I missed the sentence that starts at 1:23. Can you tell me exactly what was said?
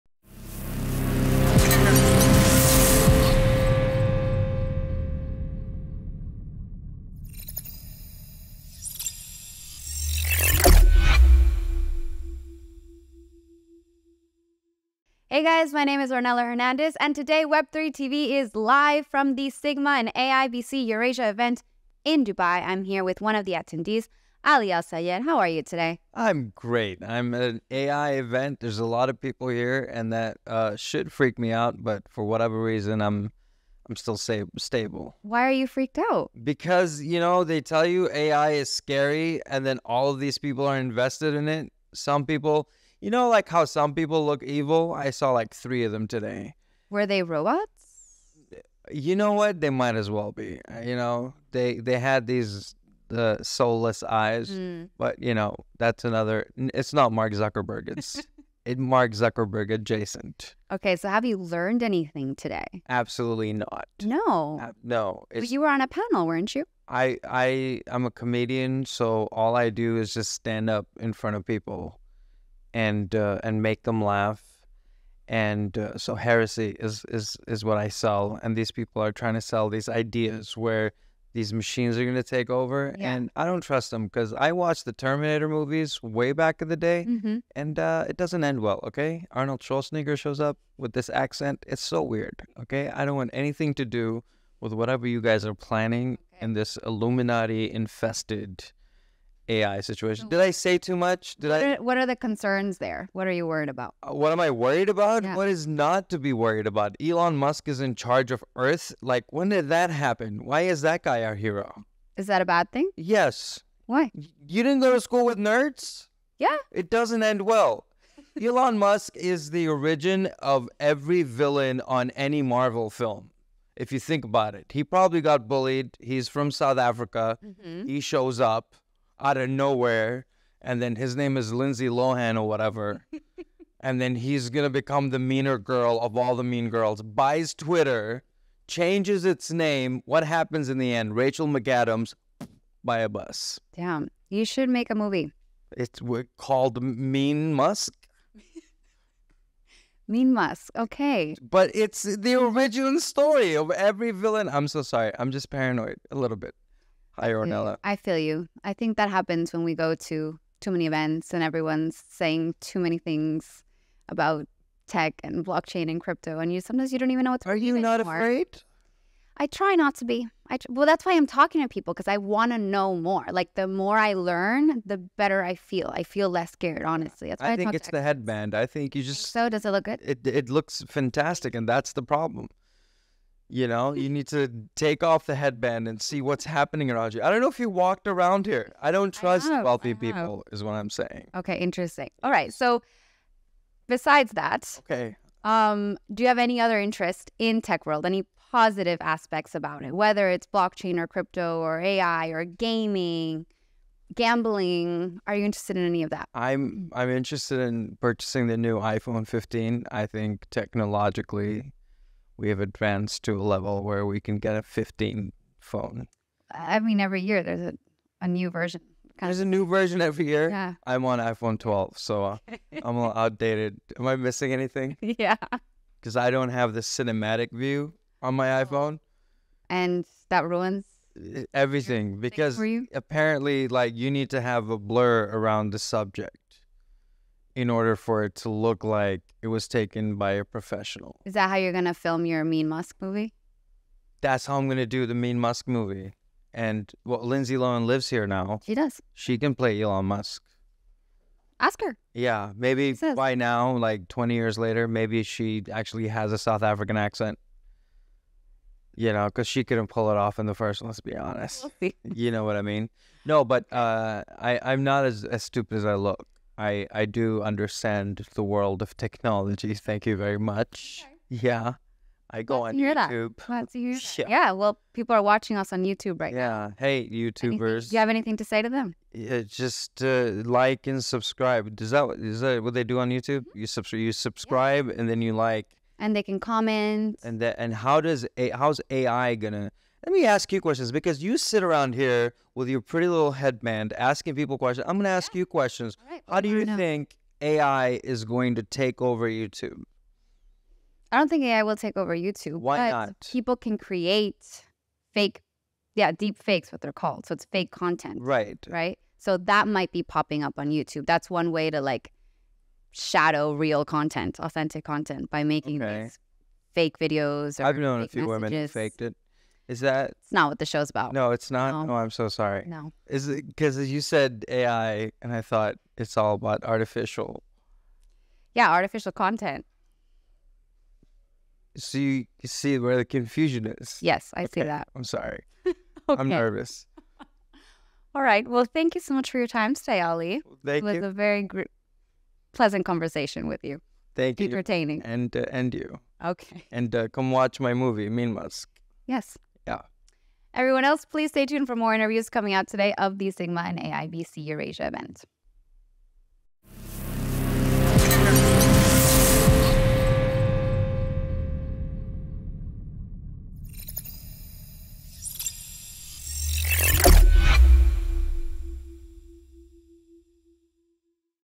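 and i don't trust them because i watched the terminator movies way back in the day mm-hmm.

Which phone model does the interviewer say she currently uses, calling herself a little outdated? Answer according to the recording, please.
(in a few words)
iPhone 12.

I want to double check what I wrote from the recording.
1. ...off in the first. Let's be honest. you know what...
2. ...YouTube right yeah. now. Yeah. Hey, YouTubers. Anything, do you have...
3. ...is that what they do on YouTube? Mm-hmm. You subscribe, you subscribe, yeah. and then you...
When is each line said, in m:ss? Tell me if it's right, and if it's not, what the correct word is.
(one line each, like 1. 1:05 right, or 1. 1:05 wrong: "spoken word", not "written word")
1. 4:20 right
2. 4:35 right
3. 4:42 right.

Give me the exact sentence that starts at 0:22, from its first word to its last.
I'm here with one of the attendees, Ali Al Sayed.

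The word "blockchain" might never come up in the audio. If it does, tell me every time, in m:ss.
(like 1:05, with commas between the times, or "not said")
2:45, 3:20.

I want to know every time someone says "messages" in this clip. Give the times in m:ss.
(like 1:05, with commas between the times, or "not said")
5:18.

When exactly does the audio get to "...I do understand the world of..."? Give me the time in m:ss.
4:26.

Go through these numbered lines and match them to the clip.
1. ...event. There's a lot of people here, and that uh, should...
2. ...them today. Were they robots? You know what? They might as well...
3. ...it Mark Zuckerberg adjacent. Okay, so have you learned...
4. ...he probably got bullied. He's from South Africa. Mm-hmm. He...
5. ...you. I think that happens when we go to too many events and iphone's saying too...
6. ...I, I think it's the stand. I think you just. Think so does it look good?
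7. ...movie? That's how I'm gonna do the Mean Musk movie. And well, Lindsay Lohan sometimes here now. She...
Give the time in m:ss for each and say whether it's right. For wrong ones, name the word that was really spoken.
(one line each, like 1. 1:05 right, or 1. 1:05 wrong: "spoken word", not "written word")
1. 0:28 right
2. 0:45 right
3. 0:58 right
4. 2:04 right
5. 2:38 wrong: "everyone", not "iphone"
6. 2:57 wrong: "headband", not "stand"
7. 4:03 wrong: "lives", not "sometimes".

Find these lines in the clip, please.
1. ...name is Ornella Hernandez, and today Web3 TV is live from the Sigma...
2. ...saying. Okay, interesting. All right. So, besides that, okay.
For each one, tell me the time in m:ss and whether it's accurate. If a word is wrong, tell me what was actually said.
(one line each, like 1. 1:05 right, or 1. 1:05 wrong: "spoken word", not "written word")
1. 0:15 right
2. 3:10 right.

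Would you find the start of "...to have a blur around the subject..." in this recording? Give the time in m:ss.
3:54.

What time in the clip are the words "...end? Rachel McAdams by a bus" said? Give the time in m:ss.
2:20.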